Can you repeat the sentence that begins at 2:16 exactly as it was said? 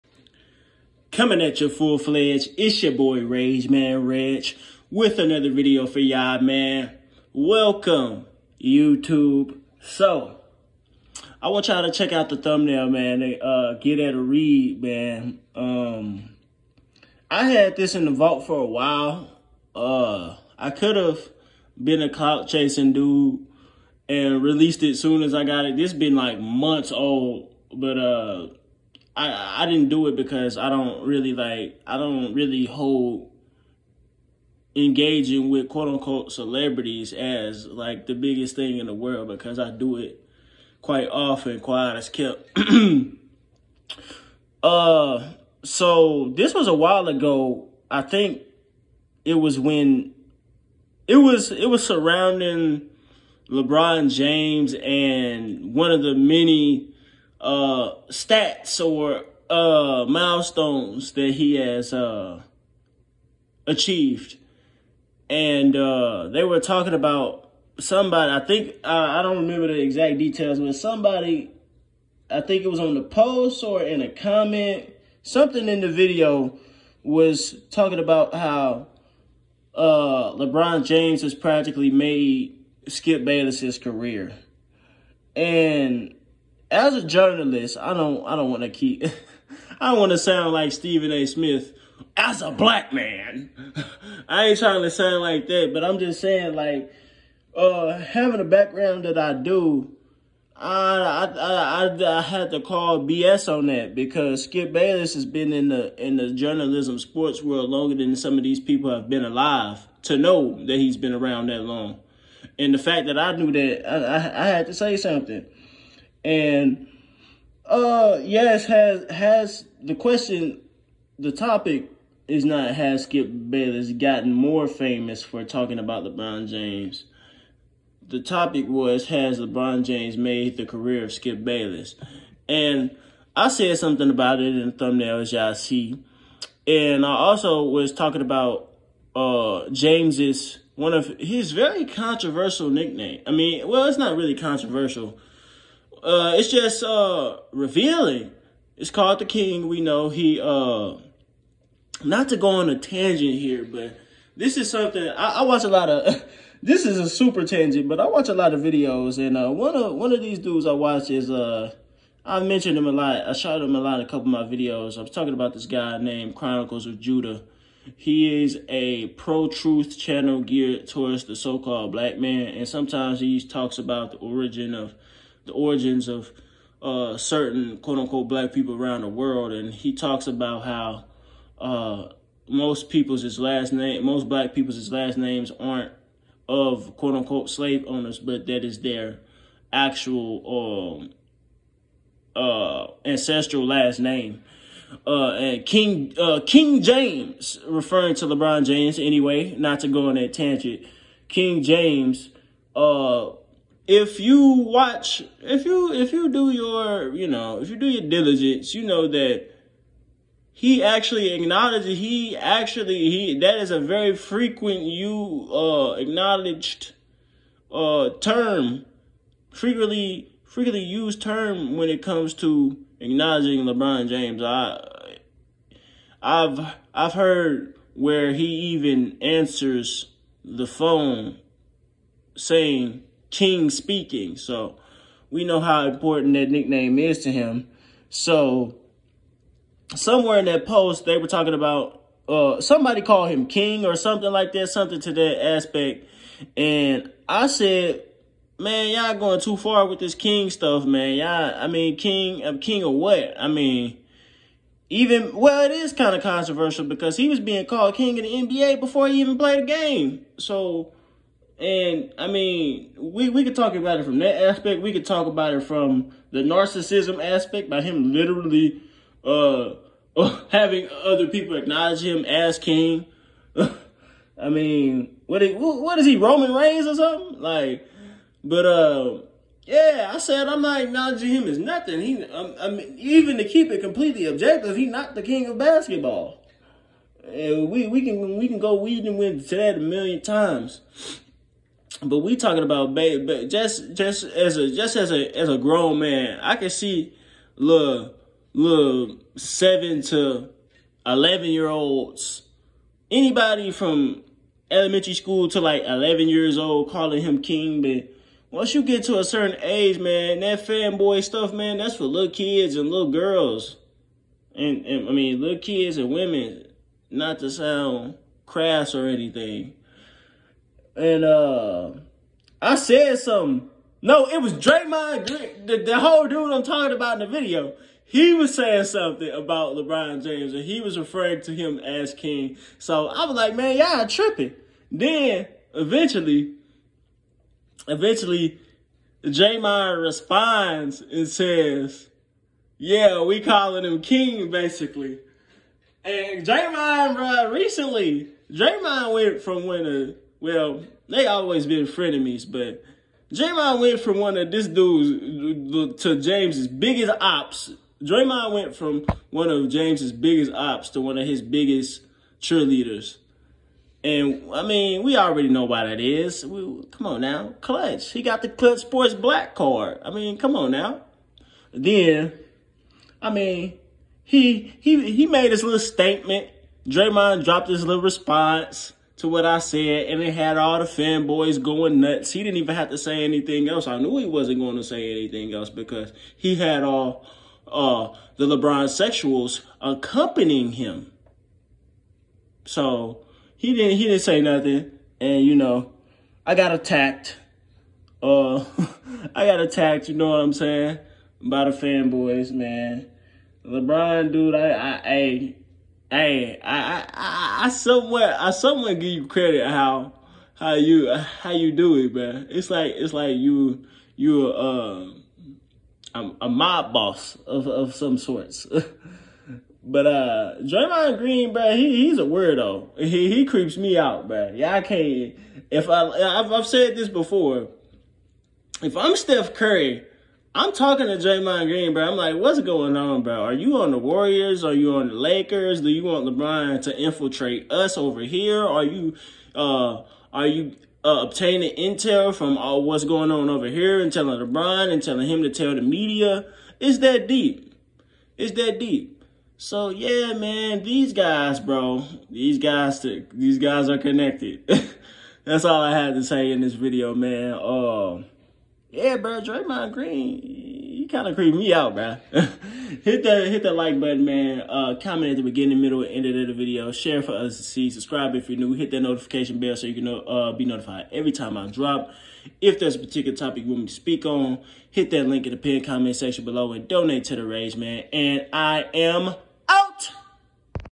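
And I also was talking about uh James's one of his very controversial nickname.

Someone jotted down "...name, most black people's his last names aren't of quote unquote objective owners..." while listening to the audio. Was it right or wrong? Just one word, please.
wrong.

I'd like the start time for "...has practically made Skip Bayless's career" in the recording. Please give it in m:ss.
1:21.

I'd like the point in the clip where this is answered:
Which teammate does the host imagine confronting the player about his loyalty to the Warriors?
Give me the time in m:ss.
7:09.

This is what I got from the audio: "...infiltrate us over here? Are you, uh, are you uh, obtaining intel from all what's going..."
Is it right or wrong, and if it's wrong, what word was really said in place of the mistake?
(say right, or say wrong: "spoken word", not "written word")
right.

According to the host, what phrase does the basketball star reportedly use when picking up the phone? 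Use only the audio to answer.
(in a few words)
King speaking.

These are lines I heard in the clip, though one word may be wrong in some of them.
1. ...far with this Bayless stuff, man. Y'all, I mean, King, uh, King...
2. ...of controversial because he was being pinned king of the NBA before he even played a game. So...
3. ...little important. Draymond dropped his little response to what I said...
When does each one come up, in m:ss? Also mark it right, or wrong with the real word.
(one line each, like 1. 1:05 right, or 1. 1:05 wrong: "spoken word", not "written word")
1. 4:09 wrong: "King", not "Bayless"
2. 4:16 wrong: "called", not "pinned"
3. 6:15 wrong: "statement", not "important".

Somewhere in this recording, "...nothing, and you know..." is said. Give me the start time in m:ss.
6:34.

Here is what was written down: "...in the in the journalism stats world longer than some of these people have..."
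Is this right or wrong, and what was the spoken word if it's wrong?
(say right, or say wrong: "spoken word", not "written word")
wrong: "sports", not "stats".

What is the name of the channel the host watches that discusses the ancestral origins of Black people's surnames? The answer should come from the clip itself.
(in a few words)
Chronicles of Judah.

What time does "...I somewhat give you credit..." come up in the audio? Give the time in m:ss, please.
6:48.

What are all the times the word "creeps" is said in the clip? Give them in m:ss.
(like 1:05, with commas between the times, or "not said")
7:03, 7:41.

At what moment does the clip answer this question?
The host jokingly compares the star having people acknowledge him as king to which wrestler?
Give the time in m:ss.
4:36.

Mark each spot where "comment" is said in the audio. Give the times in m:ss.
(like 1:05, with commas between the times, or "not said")
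1:14, 7:45, 7:55.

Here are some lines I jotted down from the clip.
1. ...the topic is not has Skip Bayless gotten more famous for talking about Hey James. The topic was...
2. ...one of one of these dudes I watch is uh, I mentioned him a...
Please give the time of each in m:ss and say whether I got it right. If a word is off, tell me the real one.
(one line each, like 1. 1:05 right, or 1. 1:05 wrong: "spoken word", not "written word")
1. 2:01 wrong: "LeBron", not "Hey"
2. 2:39 right.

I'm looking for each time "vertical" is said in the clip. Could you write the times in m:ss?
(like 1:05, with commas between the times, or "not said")
not said.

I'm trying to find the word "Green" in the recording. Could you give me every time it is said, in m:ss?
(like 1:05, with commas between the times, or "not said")
5:25, 7:01, 7:11, 7:39.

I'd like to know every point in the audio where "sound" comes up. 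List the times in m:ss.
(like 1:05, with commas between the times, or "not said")
1:30, 1:34, 5:17.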